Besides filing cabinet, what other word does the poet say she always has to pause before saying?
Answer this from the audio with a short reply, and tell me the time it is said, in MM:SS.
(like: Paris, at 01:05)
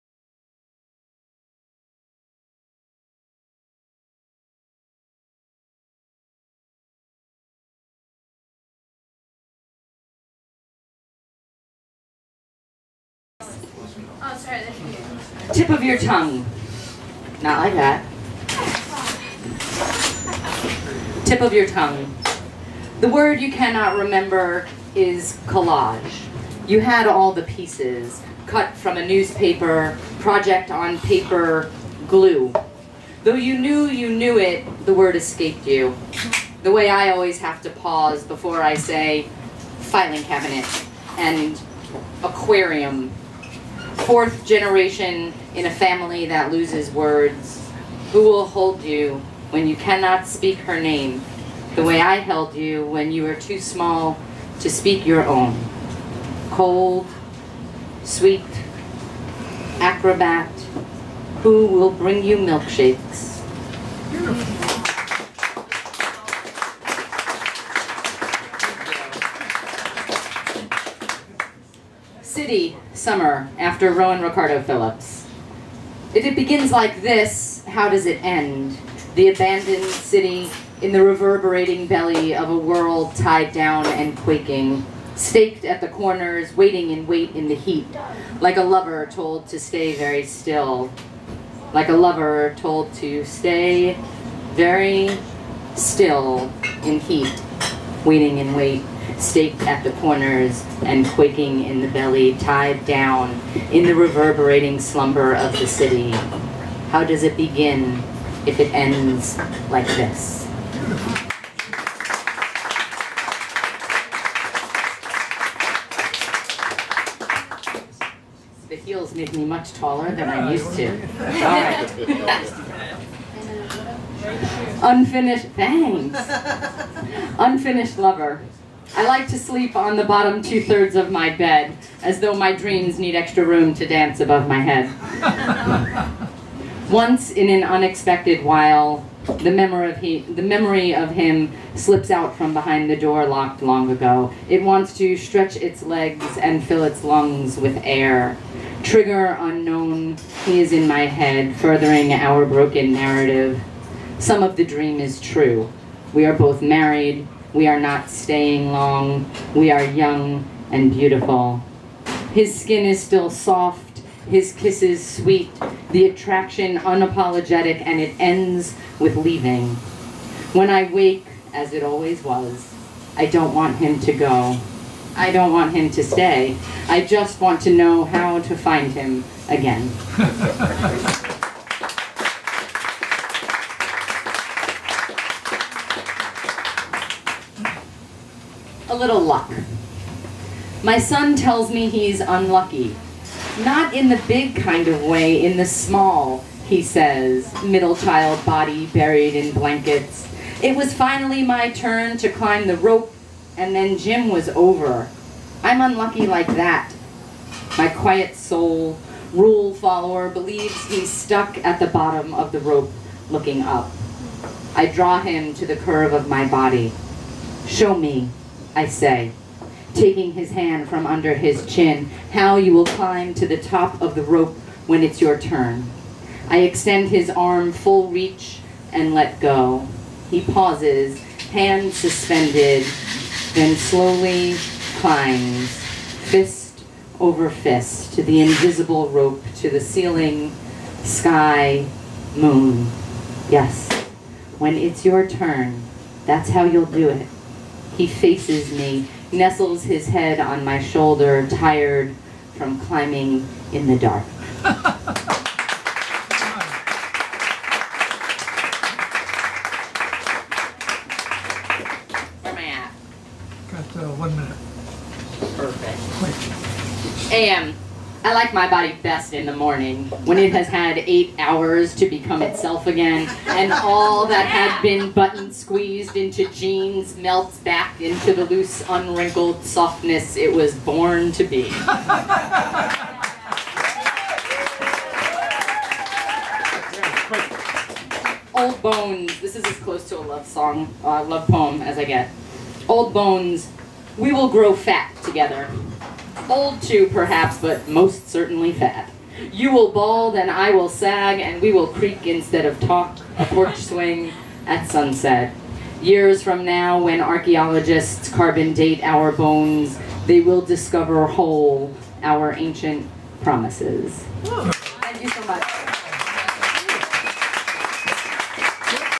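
aquarium, at 00:42.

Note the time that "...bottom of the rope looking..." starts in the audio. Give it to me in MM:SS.
03:31.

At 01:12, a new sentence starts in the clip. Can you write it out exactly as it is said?
City Summer after Rowan Ricardo Phillips.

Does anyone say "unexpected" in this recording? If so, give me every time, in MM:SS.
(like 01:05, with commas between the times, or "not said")
02:17.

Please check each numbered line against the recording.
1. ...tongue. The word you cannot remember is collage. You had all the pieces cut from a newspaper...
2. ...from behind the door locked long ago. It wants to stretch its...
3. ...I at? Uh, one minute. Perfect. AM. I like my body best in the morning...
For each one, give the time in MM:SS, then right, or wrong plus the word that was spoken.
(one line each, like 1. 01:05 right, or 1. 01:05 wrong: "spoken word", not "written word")
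1. 00:21 right
2. 02:22 right
3. 04:22 right.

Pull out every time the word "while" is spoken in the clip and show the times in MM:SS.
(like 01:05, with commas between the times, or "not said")
02:18.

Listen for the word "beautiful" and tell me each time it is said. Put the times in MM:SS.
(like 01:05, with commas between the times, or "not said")
01:04, 02:40.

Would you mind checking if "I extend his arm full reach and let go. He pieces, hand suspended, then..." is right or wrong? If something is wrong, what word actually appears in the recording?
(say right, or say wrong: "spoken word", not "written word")
wrong: "pauses", not "pieces".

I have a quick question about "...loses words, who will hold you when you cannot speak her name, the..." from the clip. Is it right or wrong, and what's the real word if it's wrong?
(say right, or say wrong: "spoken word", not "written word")
right.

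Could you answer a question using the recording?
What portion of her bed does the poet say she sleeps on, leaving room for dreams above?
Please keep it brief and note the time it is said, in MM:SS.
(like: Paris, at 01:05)
bottom two-thirds, at 02:10.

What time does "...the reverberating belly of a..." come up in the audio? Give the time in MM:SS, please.
01:20.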